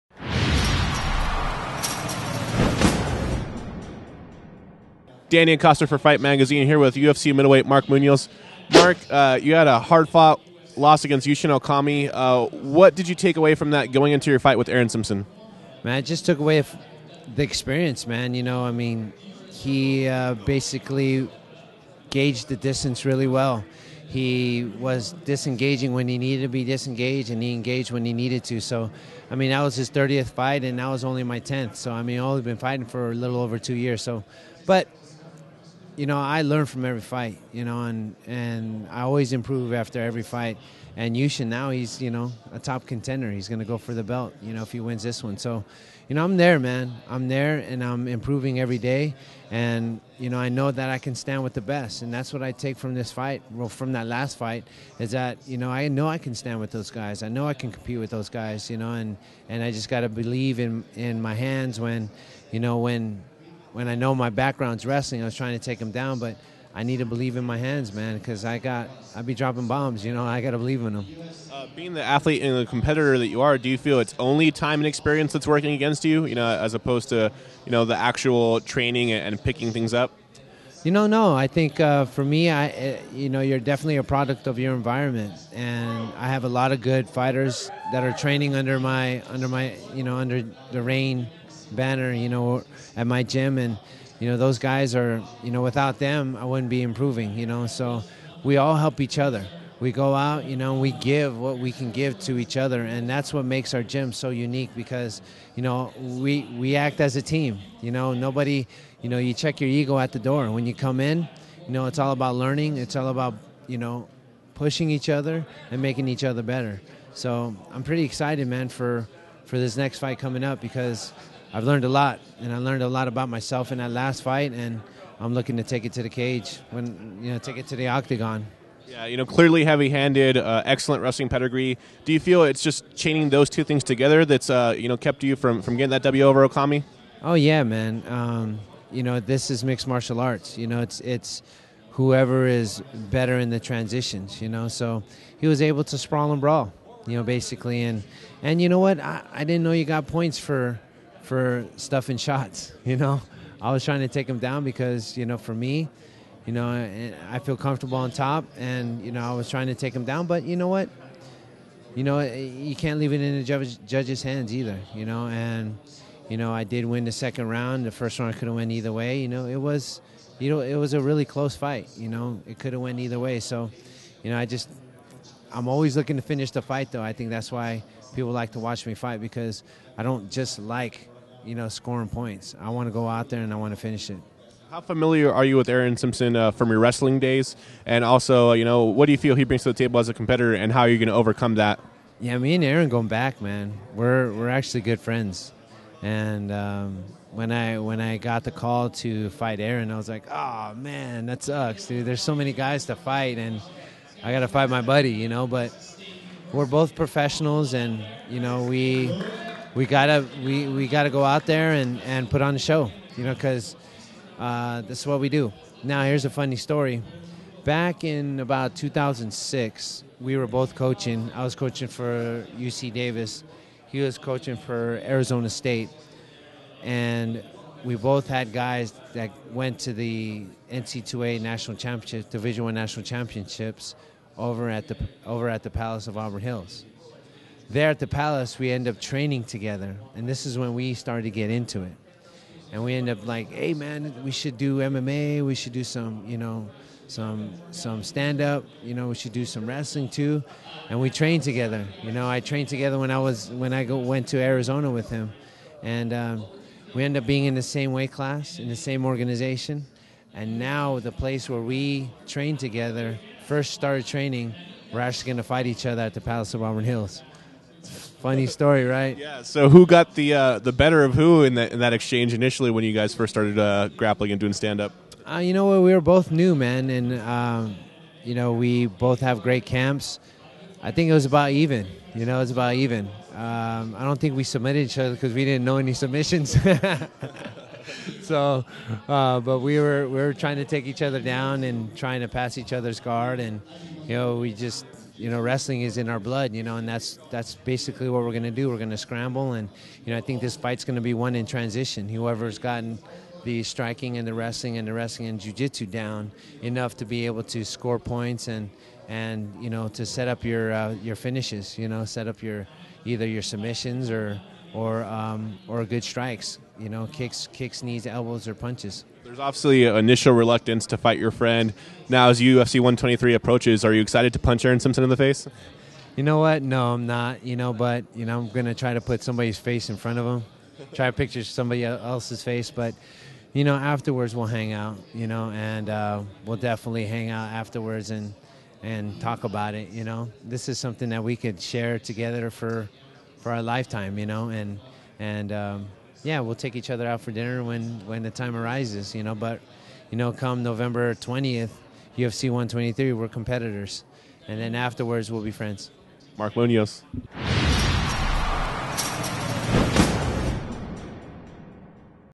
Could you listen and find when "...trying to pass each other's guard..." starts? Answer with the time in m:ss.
4:51.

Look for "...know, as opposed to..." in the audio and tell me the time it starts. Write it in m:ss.
1:16.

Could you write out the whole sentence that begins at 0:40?
And Yushin now he's you know a top contender.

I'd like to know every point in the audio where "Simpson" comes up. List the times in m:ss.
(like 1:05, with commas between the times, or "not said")
0:14, 3:05, 5:24.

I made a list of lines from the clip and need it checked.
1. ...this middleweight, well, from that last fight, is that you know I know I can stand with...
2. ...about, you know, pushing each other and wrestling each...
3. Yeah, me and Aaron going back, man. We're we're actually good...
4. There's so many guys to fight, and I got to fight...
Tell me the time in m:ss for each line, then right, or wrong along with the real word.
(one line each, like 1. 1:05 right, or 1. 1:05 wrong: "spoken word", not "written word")
1. 0:52 wrong: "fight", not "middleweight"
2. 1:53 wrong: "making", not "wrestling"
3. 3:12 right
4. 3:22 right.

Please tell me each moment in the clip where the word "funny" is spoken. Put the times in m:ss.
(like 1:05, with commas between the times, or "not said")
3:36, 4:28.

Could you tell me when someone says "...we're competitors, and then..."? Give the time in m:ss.
5:53.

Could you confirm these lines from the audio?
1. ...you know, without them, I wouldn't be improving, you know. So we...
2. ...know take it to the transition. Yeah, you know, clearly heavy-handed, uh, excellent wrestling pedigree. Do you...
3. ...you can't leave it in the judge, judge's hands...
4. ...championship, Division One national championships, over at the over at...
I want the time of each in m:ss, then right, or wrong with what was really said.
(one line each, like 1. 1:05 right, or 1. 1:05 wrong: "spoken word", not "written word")
1. 1:35 right
2. 2:07 wrong: "octagon", not "transition"
3. 2:42 right
4. 3:51 right.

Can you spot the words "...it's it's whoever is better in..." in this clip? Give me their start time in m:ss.
2:20.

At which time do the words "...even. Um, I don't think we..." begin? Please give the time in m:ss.
4:42.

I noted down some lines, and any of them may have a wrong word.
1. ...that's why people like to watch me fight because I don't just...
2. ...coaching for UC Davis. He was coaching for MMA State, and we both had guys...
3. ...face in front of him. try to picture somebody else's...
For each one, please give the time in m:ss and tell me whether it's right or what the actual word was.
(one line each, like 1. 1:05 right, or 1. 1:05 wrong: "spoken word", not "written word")
1. 2:57 right
2. 3:41 wrong: "Arizona", not "MMA"
3. 5:29 right.